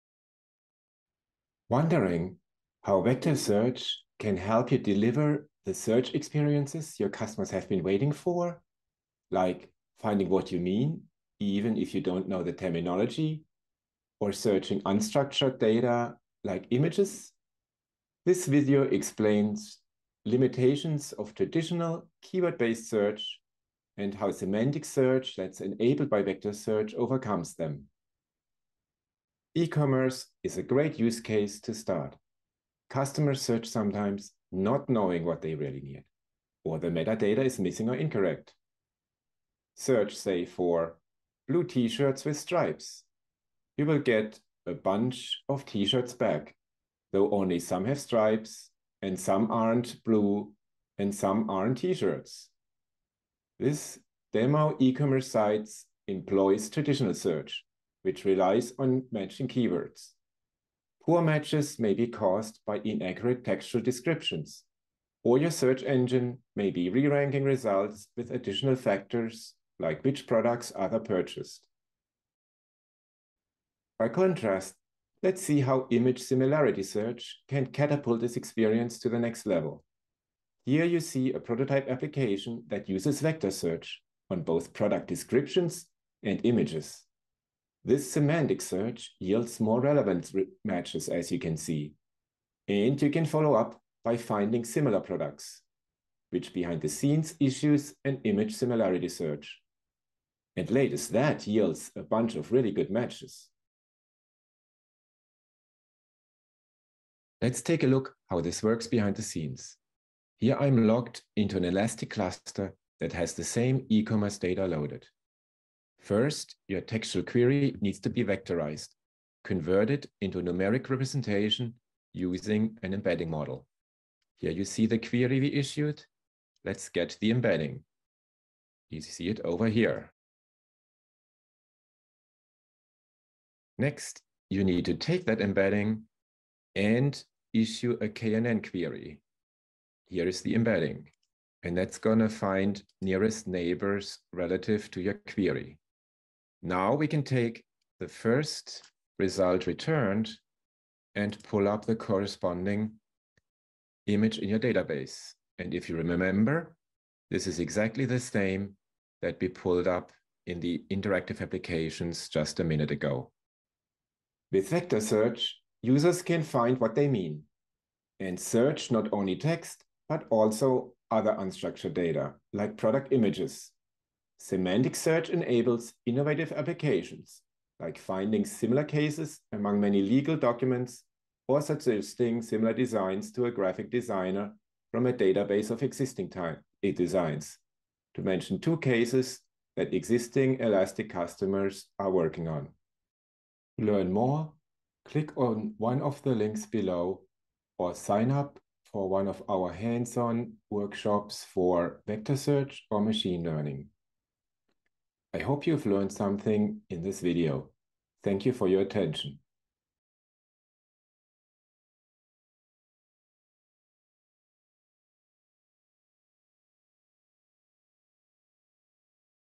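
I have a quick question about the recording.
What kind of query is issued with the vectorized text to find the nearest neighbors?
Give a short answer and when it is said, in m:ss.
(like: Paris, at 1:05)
KNN query, at 2:18.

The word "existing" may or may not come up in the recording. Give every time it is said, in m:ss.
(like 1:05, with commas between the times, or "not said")
3:05, 3:09.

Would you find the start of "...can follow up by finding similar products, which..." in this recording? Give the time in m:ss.
1:33.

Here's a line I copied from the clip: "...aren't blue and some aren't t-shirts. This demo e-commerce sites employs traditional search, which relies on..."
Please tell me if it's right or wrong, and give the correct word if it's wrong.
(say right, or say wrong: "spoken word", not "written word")
right.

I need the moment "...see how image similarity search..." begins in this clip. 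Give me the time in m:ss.
1:15.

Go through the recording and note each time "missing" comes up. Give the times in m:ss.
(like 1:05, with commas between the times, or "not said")
0:37.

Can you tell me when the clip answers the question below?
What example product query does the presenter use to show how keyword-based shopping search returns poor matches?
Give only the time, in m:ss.
0:41.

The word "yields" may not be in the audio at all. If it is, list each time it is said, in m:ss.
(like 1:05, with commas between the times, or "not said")
1:29, 1:41.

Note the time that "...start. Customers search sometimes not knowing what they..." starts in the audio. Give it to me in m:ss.
0:31.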